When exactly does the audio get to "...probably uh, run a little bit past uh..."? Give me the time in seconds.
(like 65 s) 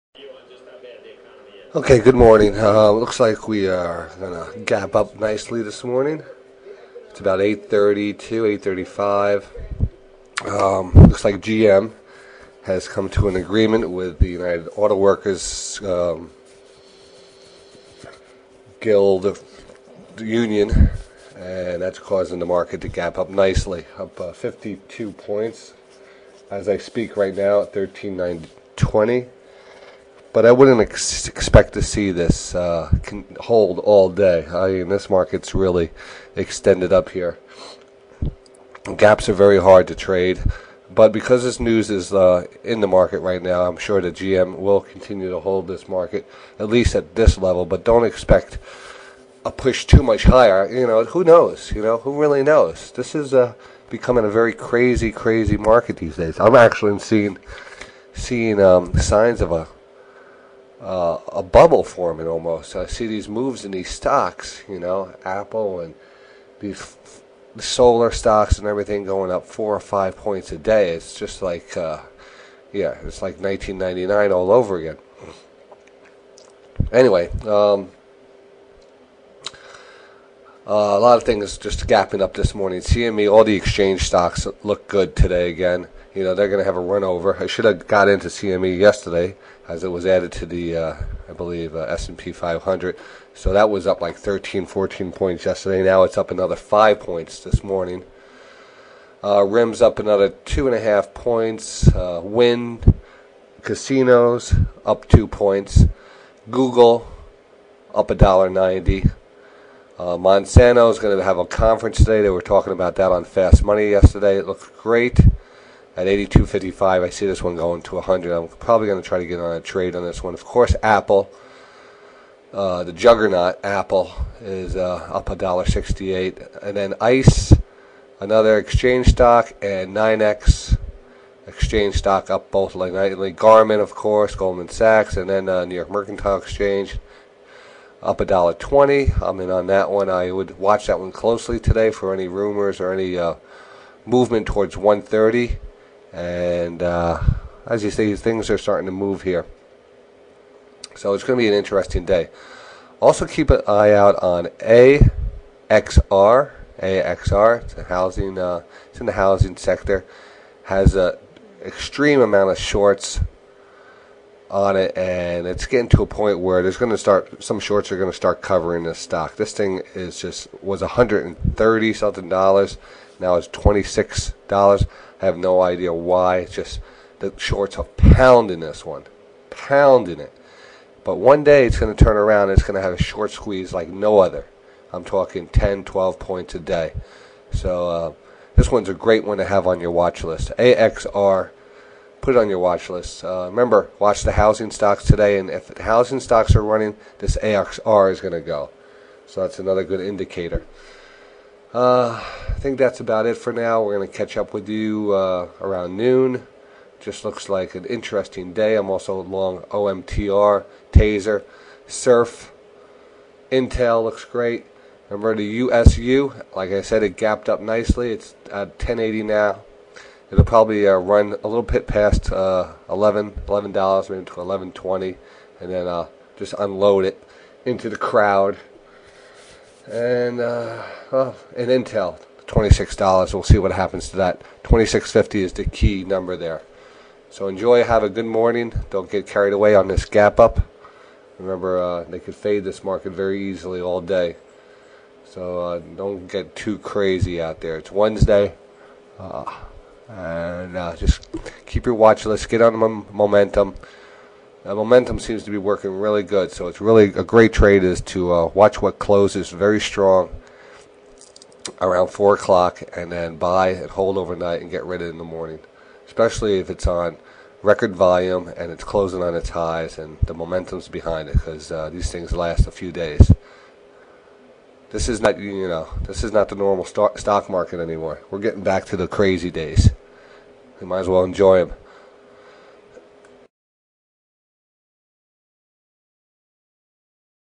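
220 s.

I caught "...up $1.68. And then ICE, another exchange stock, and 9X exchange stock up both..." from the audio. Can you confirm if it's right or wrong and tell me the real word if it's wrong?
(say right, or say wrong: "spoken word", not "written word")
right.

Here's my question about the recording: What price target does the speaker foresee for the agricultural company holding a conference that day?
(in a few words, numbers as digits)
100.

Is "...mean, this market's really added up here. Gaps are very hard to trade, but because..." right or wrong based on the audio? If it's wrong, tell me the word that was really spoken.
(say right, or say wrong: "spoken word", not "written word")
wrong: "extended", not "added".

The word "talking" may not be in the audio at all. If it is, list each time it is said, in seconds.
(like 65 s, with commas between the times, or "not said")
112 s, 185 s.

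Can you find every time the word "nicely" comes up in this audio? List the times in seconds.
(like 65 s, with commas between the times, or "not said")
5 s, 23 s, 217 s.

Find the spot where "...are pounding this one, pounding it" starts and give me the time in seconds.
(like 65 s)
177 s.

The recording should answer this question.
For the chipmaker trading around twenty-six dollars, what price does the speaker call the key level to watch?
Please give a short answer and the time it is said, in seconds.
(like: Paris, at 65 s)
26.50, at 234 s.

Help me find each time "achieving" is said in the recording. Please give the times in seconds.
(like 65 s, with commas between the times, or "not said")
not said.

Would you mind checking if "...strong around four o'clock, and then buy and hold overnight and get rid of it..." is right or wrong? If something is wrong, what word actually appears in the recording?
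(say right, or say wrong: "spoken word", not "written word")
right.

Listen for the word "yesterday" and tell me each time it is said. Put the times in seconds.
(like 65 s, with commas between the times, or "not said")
88 s, 95 s, 113 s.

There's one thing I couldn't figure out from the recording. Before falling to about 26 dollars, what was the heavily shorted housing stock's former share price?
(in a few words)
130 something dollars.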